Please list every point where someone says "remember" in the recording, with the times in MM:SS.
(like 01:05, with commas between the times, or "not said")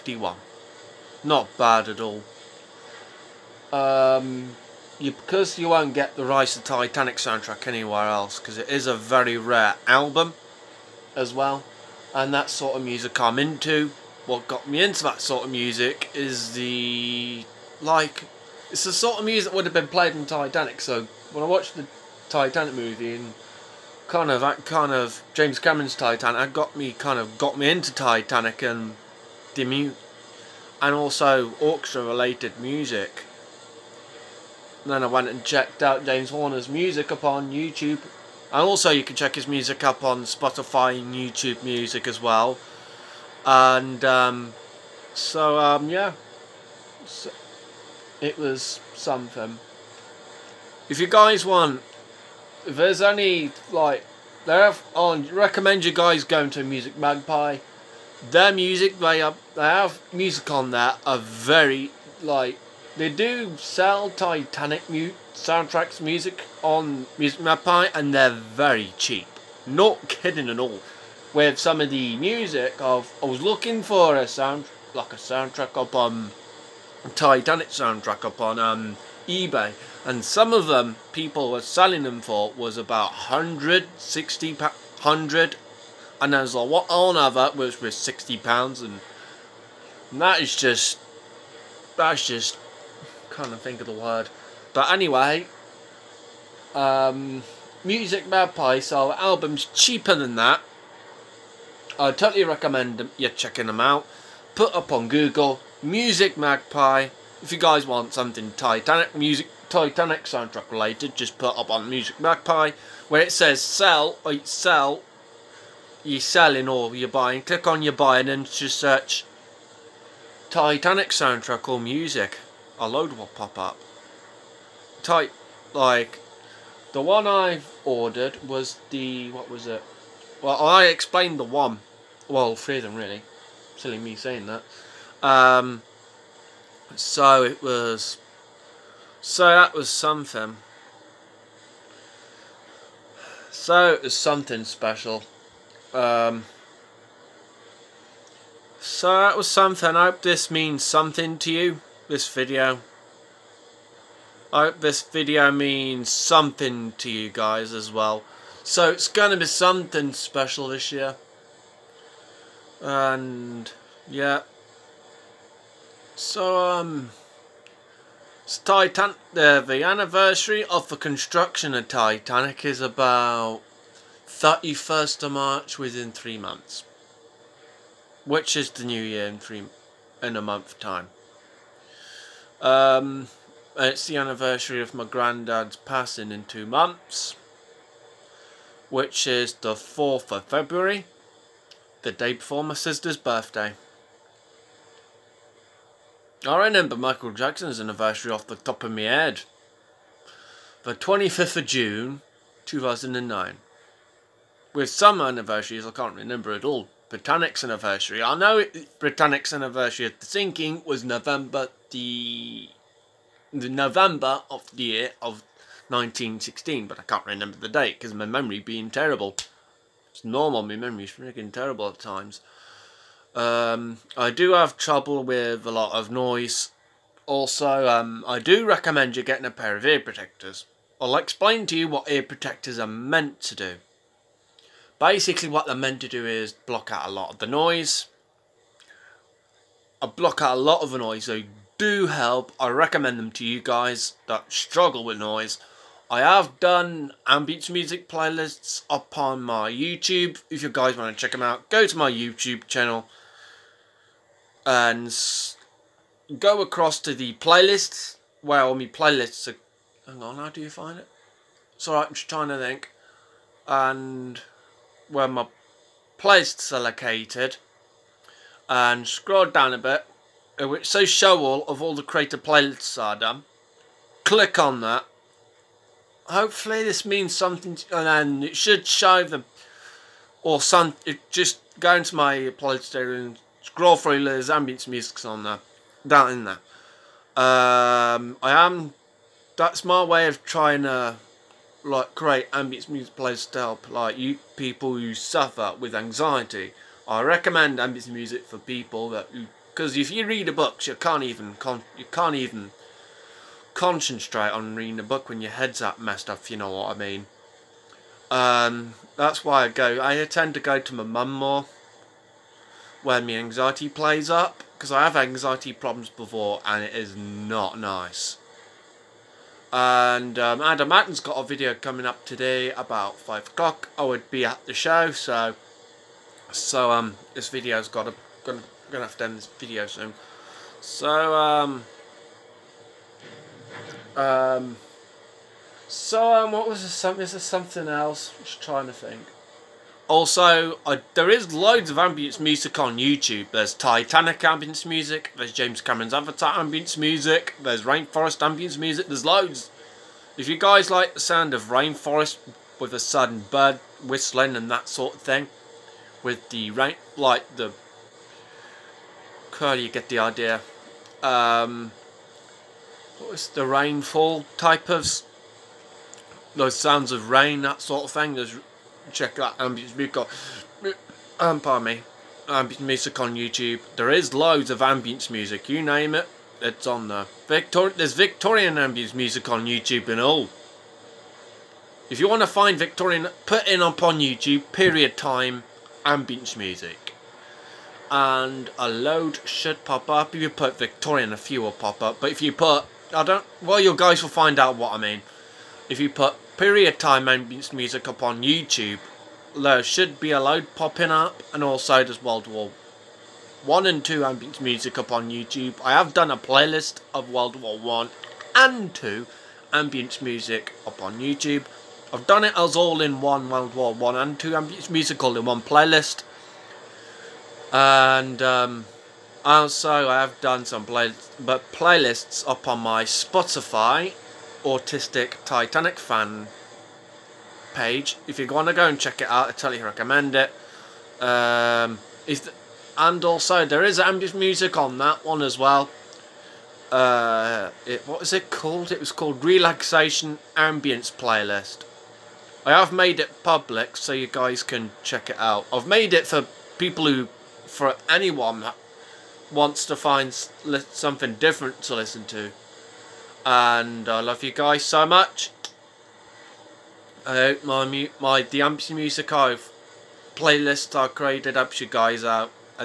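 03:16, 03:26, 03:37.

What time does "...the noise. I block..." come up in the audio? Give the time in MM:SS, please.
03:57.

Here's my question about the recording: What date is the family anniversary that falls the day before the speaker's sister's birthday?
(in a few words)
4th of February.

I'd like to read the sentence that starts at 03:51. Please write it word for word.
I'll explain to you what ear protectors are meant to do.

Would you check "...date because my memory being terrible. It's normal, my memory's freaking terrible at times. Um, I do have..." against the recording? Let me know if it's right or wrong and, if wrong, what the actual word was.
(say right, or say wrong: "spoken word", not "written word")
right.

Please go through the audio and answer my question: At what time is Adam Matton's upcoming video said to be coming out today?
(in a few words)
5 o'clock.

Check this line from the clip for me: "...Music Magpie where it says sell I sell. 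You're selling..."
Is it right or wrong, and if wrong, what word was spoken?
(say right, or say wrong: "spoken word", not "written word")
right.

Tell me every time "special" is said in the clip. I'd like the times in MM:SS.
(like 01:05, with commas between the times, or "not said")
02:24, 02:40.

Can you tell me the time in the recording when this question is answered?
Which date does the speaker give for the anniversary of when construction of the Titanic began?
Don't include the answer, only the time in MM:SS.
02:54.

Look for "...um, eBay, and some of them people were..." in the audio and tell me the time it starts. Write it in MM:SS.
01:18.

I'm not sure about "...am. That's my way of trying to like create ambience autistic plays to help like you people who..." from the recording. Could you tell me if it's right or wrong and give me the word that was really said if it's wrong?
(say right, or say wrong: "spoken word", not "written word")
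wrong: "music", not "autistic".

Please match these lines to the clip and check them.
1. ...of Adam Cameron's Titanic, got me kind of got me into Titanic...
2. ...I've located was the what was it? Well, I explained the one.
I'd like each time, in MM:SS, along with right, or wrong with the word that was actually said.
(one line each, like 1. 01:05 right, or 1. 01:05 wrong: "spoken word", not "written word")
1. 00:24 wrong: "James", not "Adam"
2. 02:07 wrong: "ordered", not "located".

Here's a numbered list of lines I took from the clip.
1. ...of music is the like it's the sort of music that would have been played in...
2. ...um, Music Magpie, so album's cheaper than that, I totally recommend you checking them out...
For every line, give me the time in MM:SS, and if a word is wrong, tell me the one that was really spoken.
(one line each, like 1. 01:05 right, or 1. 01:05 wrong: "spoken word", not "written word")
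1. 00:15 right
2. 01:36 right.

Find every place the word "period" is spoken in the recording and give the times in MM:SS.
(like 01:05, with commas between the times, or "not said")
06:24, 06:36.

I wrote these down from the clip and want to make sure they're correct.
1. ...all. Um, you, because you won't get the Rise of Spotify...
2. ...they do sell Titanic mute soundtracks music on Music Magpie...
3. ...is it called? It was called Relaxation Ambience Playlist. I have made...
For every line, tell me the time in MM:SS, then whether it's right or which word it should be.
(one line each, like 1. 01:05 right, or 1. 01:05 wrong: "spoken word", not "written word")
1. 00:02 wrong: "Titanic", not "Spotify"
2. 01:02 right
3. 07:18 right.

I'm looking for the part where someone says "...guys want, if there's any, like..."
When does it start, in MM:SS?
00:51.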